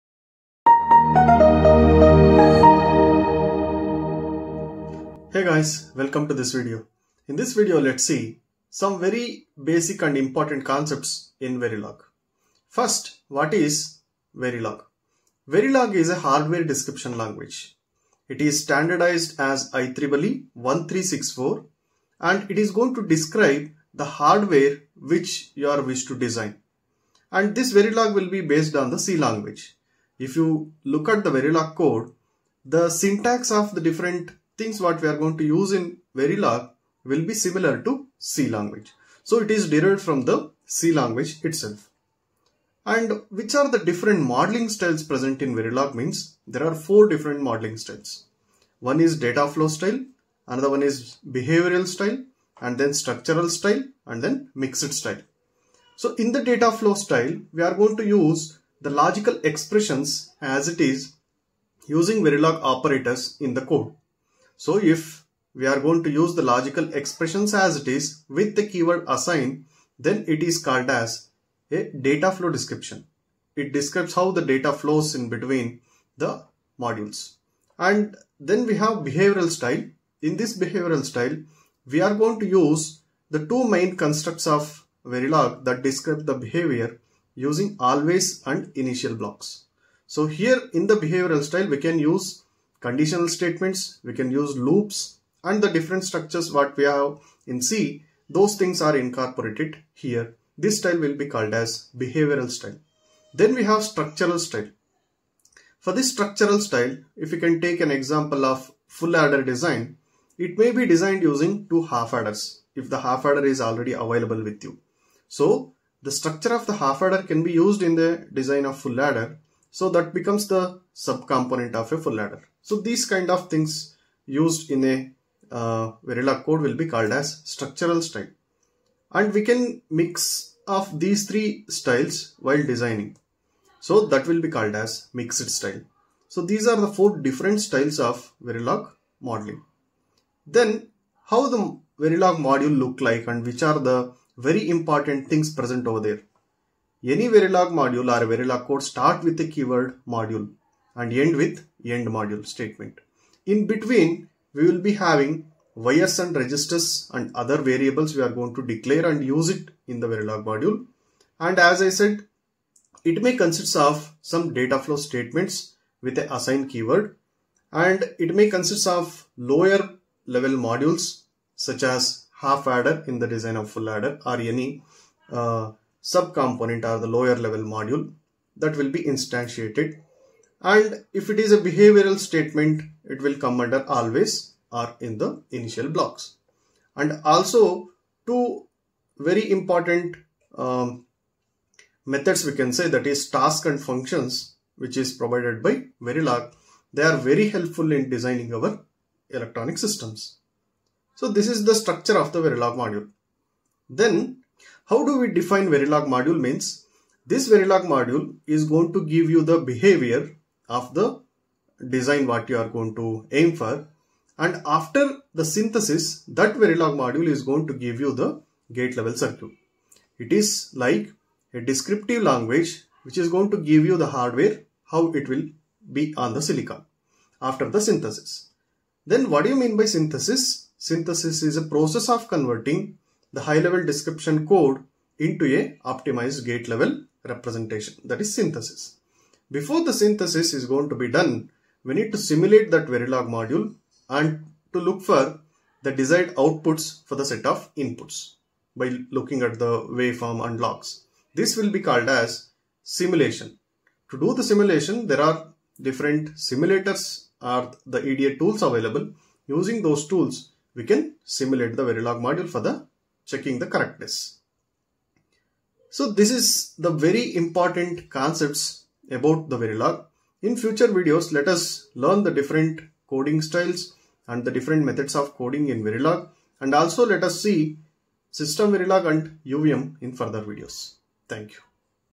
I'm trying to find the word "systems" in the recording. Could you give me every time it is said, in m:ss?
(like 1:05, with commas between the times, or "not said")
3:19, 4:38.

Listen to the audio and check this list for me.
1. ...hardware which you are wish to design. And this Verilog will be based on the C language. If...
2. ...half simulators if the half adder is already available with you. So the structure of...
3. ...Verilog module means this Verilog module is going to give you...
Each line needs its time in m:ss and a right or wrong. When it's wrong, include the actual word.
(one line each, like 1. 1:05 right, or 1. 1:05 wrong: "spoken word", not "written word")
1. 0:24 right
2. 1:51 wrong: "adders", not "simulators"
3. 3:25 right.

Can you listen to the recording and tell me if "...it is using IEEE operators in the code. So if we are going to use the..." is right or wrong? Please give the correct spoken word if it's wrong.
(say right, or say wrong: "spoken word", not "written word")
wrong: "Verilog", not "IEEE".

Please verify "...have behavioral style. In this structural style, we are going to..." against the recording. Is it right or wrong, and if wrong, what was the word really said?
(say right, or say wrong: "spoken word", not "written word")
wrong: "behavioral", not "structural".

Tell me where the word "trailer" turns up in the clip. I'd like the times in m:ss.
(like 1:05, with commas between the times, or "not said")
not said.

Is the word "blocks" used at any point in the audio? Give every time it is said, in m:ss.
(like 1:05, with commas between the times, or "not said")
1:29, 3:05.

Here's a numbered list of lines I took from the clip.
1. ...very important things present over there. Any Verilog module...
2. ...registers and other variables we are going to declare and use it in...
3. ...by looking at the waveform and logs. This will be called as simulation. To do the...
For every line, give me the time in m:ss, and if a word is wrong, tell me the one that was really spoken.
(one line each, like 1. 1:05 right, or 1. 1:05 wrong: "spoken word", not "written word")
1. 2:24 right
2. 2:36 right
3. 4:08 right.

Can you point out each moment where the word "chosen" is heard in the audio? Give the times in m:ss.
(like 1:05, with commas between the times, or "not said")
not said.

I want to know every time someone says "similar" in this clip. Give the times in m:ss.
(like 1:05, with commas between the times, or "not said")
0:37.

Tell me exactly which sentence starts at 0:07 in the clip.
In this video, let's see some very basic and important concepts in Verilog.